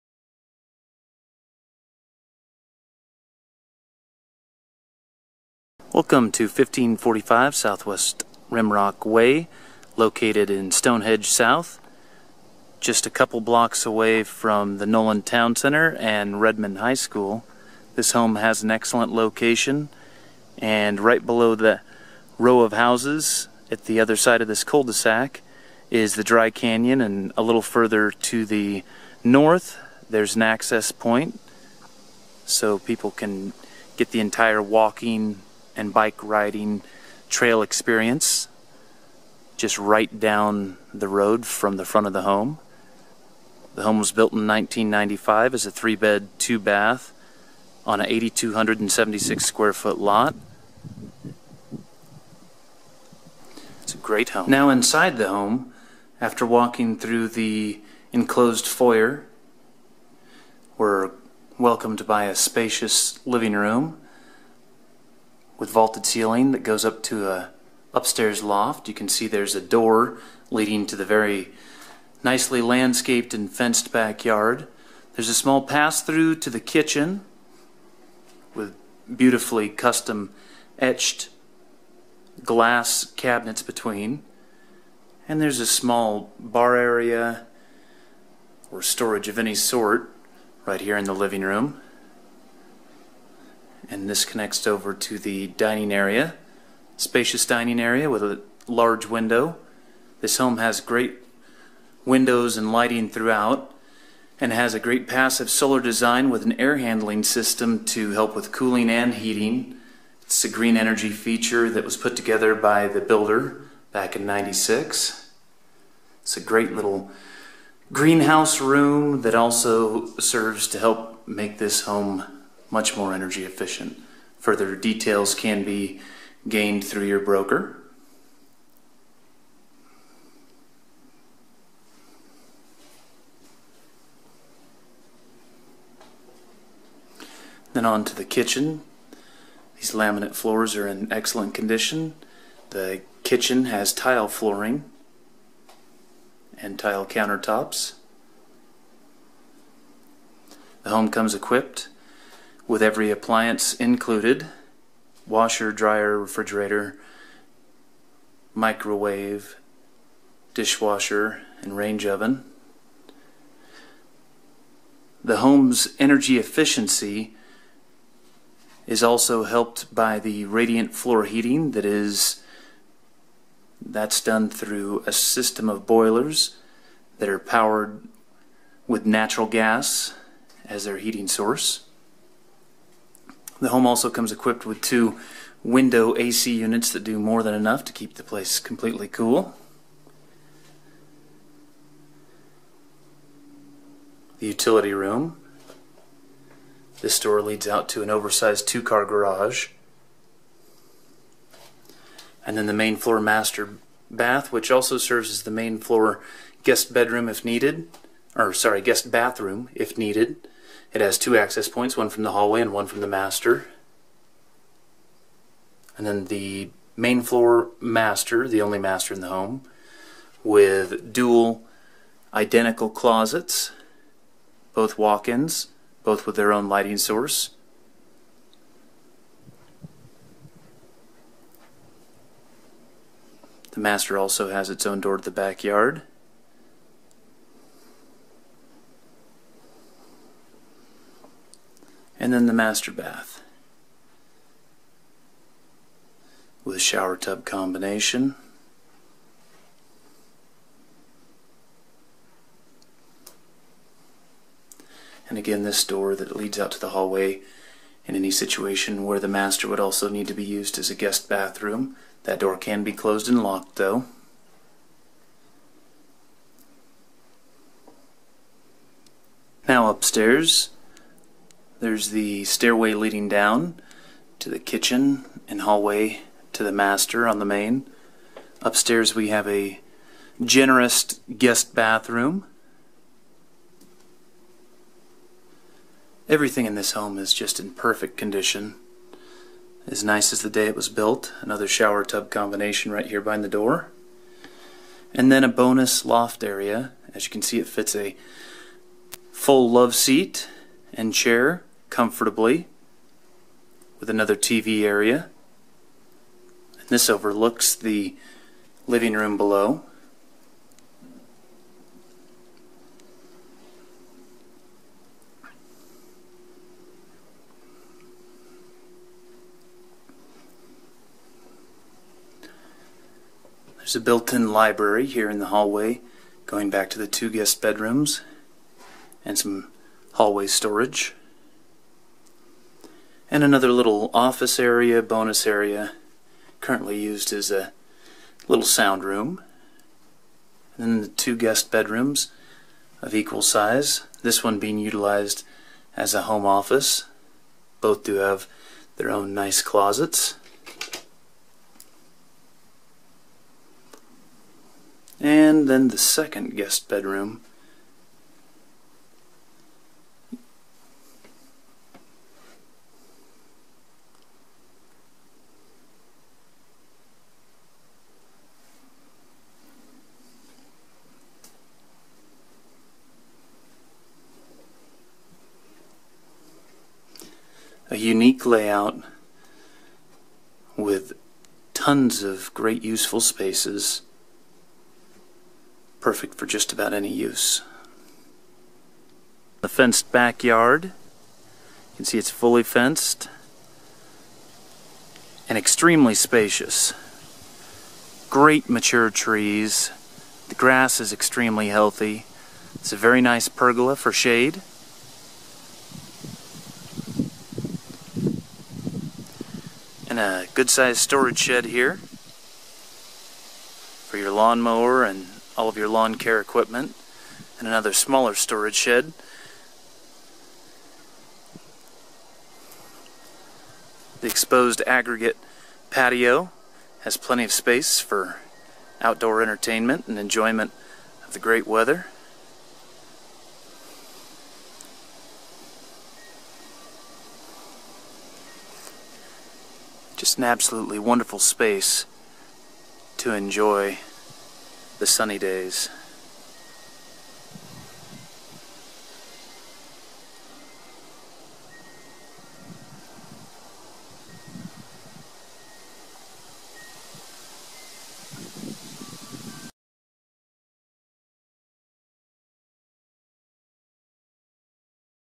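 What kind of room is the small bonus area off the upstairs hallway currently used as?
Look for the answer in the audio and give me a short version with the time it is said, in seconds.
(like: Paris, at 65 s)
Sound room, at 338 s.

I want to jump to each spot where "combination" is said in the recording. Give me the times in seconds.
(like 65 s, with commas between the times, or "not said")
247 s, 292 s.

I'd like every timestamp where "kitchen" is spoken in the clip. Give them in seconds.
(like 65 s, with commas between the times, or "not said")
76 s, 138 s, 143 s, 274 s.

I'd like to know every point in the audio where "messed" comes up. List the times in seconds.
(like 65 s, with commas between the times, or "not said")
not said.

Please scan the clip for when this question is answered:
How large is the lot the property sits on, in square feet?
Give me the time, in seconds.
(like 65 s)
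48 s.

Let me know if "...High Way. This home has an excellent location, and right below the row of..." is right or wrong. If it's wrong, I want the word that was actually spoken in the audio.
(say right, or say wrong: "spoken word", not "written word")
wrong: "School", not "Way".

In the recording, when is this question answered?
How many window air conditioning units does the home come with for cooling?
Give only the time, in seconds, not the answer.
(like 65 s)
184 s.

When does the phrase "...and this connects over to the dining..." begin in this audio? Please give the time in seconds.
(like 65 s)
93 s.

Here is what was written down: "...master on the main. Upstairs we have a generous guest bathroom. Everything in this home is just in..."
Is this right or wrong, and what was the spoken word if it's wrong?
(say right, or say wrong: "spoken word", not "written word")
right.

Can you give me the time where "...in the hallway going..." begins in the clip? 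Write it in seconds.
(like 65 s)
325 s.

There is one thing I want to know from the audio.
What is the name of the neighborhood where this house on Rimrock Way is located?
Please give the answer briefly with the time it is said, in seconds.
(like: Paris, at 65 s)
Stonehenge South, at 10 s.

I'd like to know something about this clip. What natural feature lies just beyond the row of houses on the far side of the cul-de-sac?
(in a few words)
Dry Canyon.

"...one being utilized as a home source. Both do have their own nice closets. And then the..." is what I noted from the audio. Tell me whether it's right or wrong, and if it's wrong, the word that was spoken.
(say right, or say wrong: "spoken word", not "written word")
wrong: "office", not "source".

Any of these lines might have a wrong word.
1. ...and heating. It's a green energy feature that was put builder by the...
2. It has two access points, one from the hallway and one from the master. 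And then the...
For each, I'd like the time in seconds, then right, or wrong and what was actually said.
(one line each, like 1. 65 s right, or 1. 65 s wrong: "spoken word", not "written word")
1. 108 s wrong: "together", not "builder"
2. 210 s right.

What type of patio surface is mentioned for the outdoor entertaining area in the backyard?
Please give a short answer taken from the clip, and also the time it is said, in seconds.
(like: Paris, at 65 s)
Exposed aggregate, at 424 s.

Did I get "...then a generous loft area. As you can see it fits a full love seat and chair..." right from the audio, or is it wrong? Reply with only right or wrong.
wrong.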